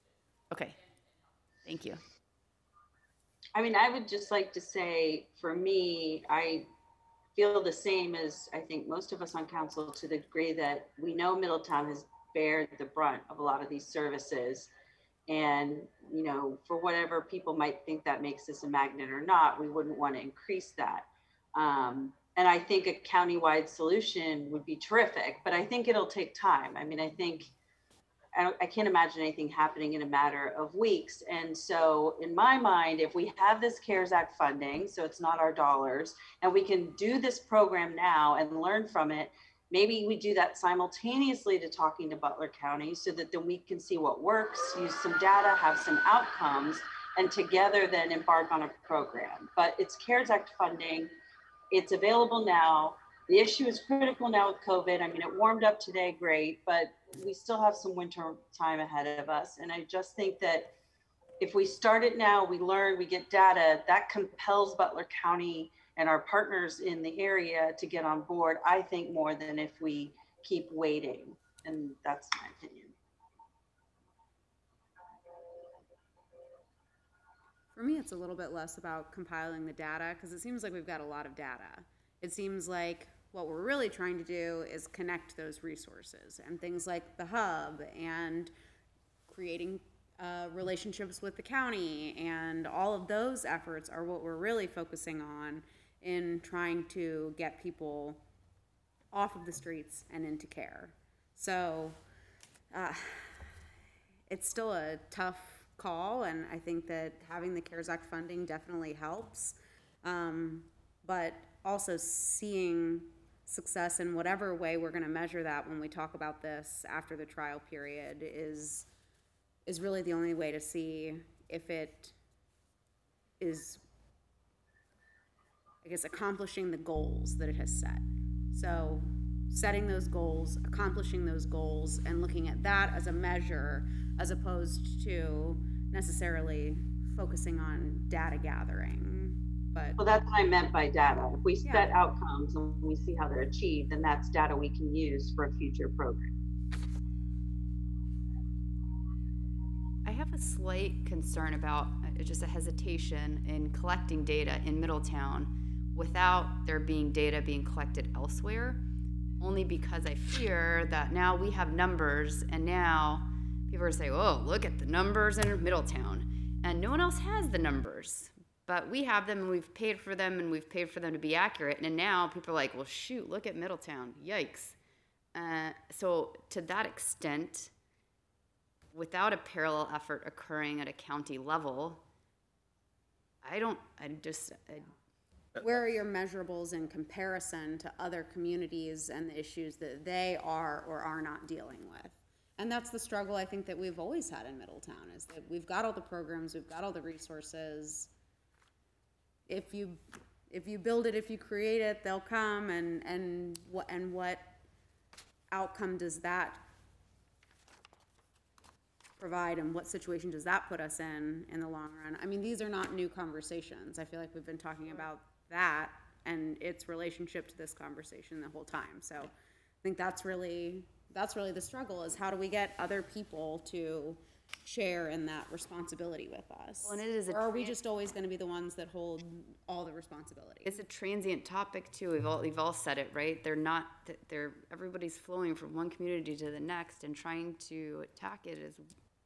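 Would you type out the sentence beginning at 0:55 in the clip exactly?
I mean, it warmed up today, great, but we still have some winter time ahead of us.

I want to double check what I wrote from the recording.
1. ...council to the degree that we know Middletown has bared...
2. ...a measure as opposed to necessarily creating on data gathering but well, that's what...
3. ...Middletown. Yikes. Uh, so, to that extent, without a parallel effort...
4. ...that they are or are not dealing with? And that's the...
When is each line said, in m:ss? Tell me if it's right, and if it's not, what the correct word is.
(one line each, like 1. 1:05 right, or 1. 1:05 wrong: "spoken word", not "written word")
1. 0:09 right
2. 2:13 wrong: "focusing", not "creating"
3. 2:53 right
4. 3:09 right.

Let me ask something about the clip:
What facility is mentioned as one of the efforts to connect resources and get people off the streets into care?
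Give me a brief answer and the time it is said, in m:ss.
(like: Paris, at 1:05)
the hub, at 1:27.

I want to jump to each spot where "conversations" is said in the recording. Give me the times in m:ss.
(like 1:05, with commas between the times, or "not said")
3:33, 3:37.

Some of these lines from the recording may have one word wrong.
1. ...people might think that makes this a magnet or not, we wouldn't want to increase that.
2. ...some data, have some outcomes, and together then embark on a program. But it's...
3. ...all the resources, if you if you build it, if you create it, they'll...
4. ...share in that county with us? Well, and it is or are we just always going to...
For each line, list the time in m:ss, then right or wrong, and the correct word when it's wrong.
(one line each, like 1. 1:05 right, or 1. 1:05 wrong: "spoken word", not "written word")
1. 0:17 right
2. 0:44 right
3. 3:16 right
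4. 3:44 wrong: "responsibility", not "county".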